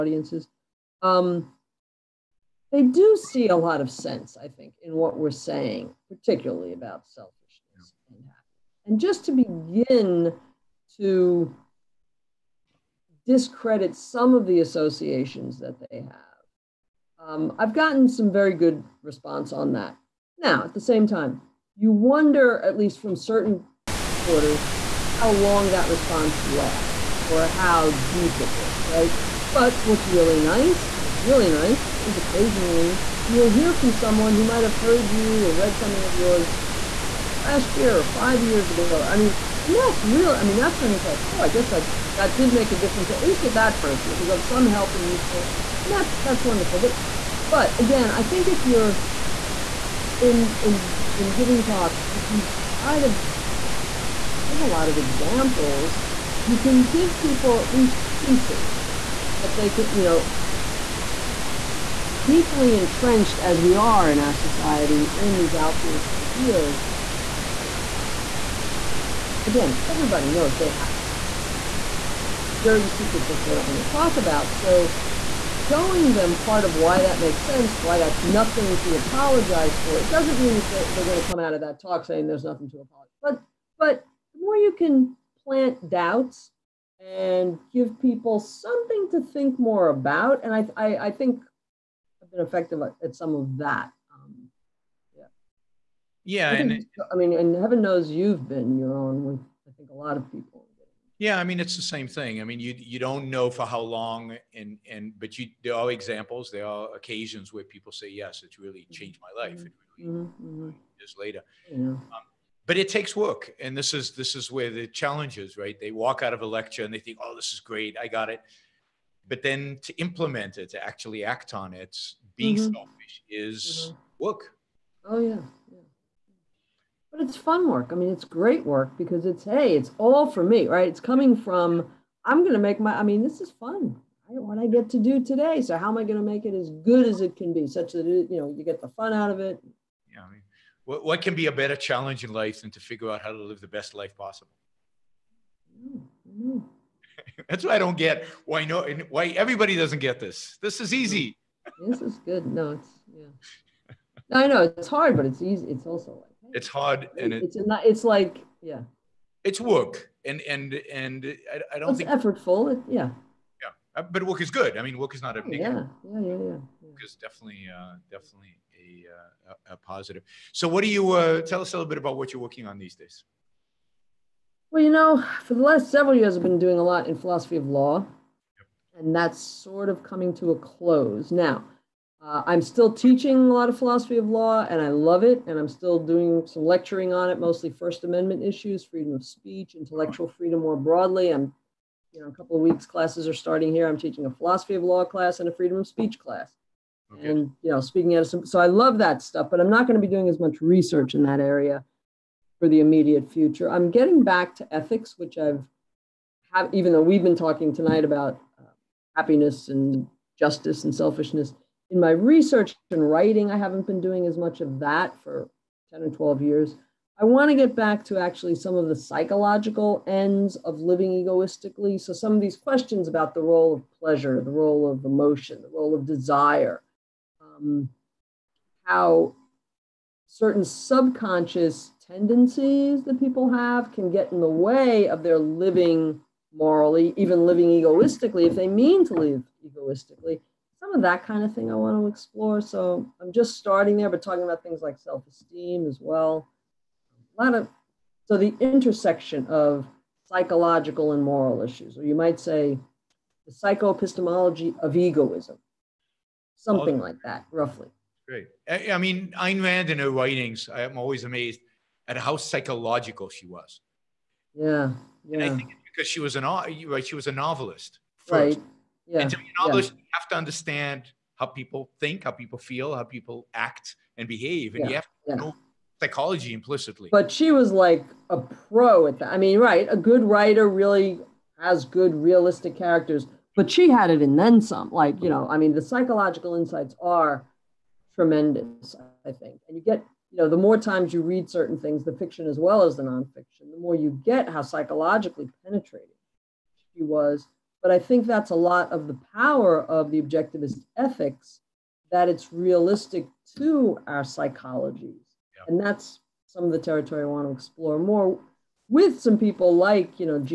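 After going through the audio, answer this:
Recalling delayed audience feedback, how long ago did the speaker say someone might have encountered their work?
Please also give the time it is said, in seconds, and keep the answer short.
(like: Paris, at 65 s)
five years ago, at 38 s.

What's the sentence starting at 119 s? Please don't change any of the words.
But then to implement it, to actually act on it, being mm-hmm.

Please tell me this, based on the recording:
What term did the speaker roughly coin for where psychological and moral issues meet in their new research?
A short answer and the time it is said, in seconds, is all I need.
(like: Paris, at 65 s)
psychoepistemology of egoism, at 253 s.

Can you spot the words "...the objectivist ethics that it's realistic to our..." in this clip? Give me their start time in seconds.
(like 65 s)
300 s.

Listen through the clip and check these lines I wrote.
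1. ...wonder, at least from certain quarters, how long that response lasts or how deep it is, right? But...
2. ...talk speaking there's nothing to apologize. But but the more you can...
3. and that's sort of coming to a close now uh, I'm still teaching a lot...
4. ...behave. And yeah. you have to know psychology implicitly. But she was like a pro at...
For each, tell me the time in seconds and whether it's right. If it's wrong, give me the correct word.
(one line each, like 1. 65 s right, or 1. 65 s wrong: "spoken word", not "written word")
1. 21 s right
2. 81 s wrong: "saying", not "speaking"
3. 179 s right
4. 274 s right.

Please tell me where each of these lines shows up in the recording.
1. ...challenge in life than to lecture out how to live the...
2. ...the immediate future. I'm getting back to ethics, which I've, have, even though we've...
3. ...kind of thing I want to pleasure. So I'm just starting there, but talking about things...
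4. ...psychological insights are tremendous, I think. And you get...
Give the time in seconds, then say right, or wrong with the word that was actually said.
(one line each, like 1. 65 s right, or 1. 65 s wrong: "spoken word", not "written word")
1. 141 s wrong: "figure", not "lecture"
2. 202 s right
3. 241 s wrong: "explore", not "pleasure"
4. 285 s right.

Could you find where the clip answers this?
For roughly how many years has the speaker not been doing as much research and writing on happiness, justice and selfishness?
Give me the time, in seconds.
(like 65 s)
215 s.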